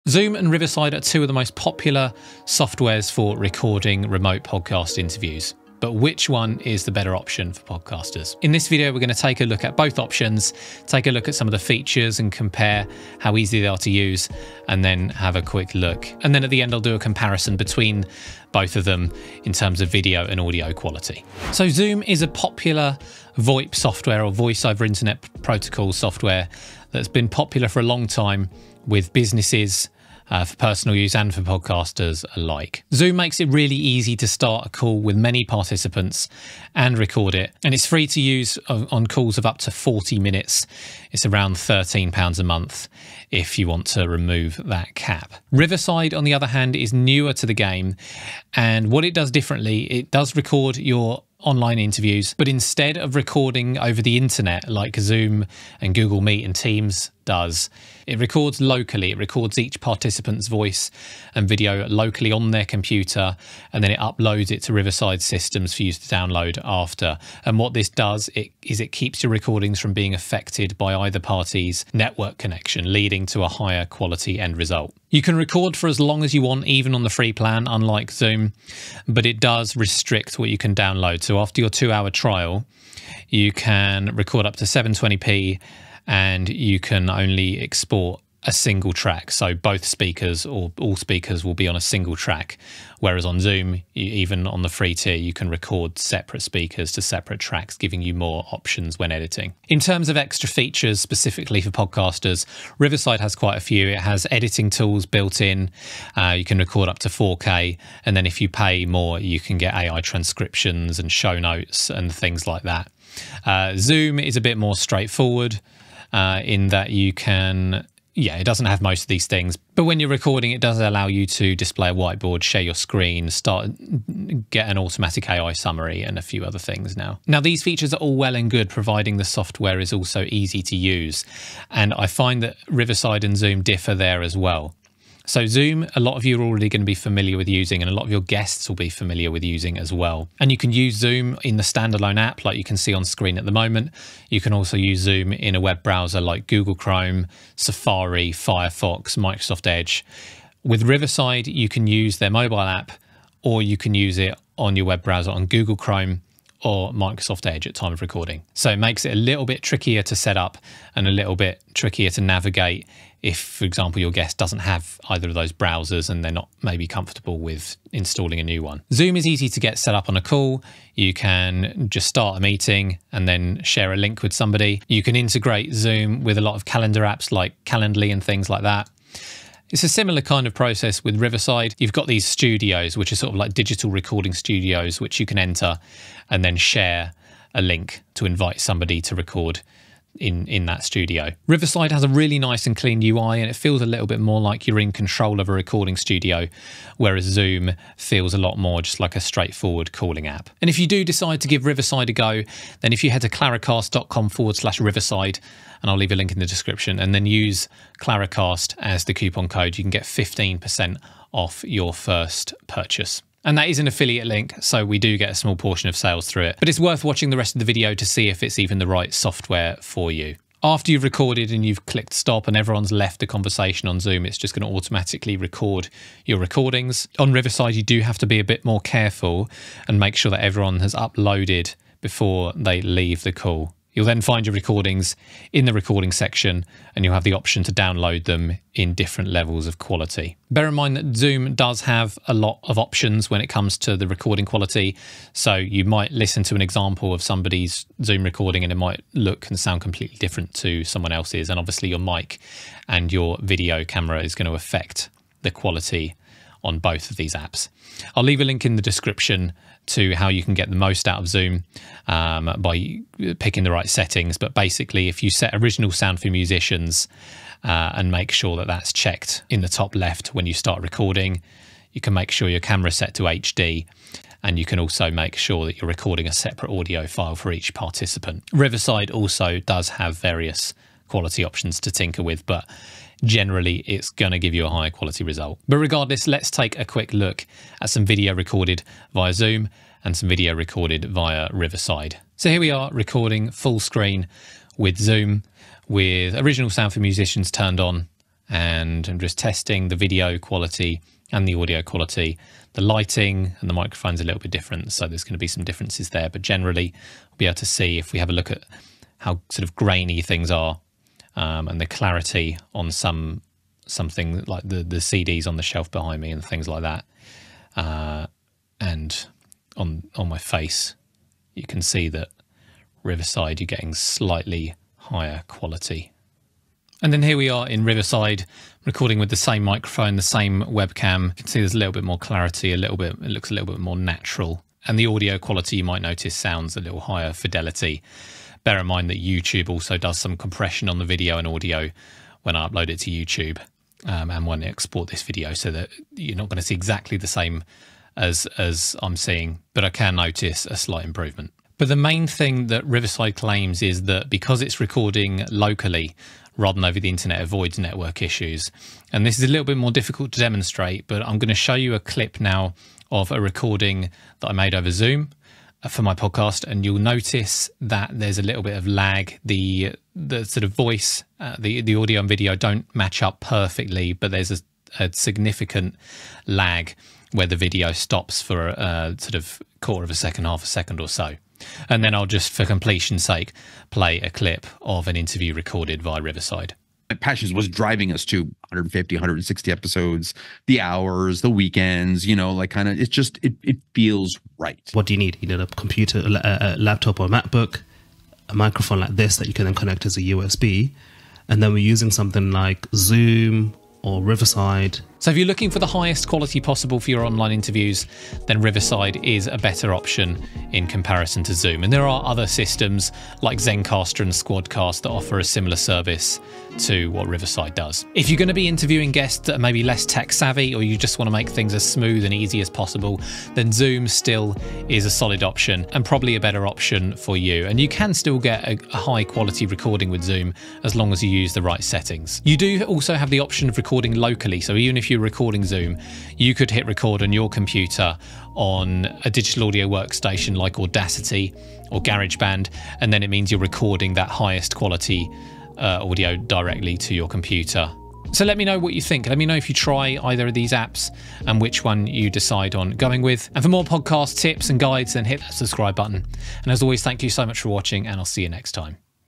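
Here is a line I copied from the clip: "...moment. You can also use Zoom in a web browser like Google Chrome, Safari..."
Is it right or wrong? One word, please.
right.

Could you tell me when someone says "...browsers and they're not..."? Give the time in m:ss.
2:45.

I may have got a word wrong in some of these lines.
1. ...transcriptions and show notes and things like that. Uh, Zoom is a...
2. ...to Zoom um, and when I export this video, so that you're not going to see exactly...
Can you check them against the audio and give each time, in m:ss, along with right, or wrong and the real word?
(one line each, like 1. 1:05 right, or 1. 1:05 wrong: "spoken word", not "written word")
1. 1:50 right
2. 5:43 wrong: "YouTube", not "Zoom".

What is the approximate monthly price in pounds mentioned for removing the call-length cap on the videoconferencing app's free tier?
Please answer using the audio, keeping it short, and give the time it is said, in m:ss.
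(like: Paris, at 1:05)
£13, at 0:41.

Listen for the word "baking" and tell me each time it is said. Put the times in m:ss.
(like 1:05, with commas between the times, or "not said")
not said.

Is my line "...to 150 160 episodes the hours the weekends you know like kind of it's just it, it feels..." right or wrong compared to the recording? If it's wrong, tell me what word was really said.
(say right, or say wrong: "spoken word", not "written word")
right.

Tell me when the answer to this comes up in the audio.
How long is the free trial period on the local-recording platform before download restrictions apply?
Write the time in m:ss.
1:21.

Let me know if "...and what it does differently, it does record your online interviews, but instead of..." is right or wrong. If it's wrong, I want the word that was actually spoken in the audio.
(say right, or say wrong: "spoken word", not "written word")
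right.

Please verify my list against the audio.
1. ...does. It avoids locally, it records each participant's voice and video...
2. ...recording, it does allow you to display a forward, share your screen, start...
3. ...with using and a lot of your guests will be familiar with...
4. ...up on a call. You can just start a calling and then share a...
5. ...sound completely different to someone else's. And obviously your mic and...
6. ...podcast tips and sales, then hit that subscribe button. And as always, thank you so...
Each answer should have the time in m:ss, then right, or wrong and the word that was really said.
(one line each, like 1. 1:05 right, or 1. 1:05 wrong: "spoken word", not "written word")
1. 0:57 wrong: "records", not "avoids"
2. 2:00 wrong: "whiteboard", not "forward"
3. 2:17 right
4. 2:49 wrong: "meeting", not "calling"
5. 4:09 right
6. 7:33 wrong: "guides", not "sales".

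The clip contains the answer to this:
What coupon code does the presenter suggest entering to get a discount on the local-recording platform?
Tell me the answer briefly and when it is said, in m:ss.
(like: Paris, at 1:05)
Claricast, at 3:28.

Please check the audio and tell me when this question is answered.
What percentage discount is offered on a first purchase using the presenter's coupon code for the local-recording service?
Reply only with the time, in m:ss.
3:30.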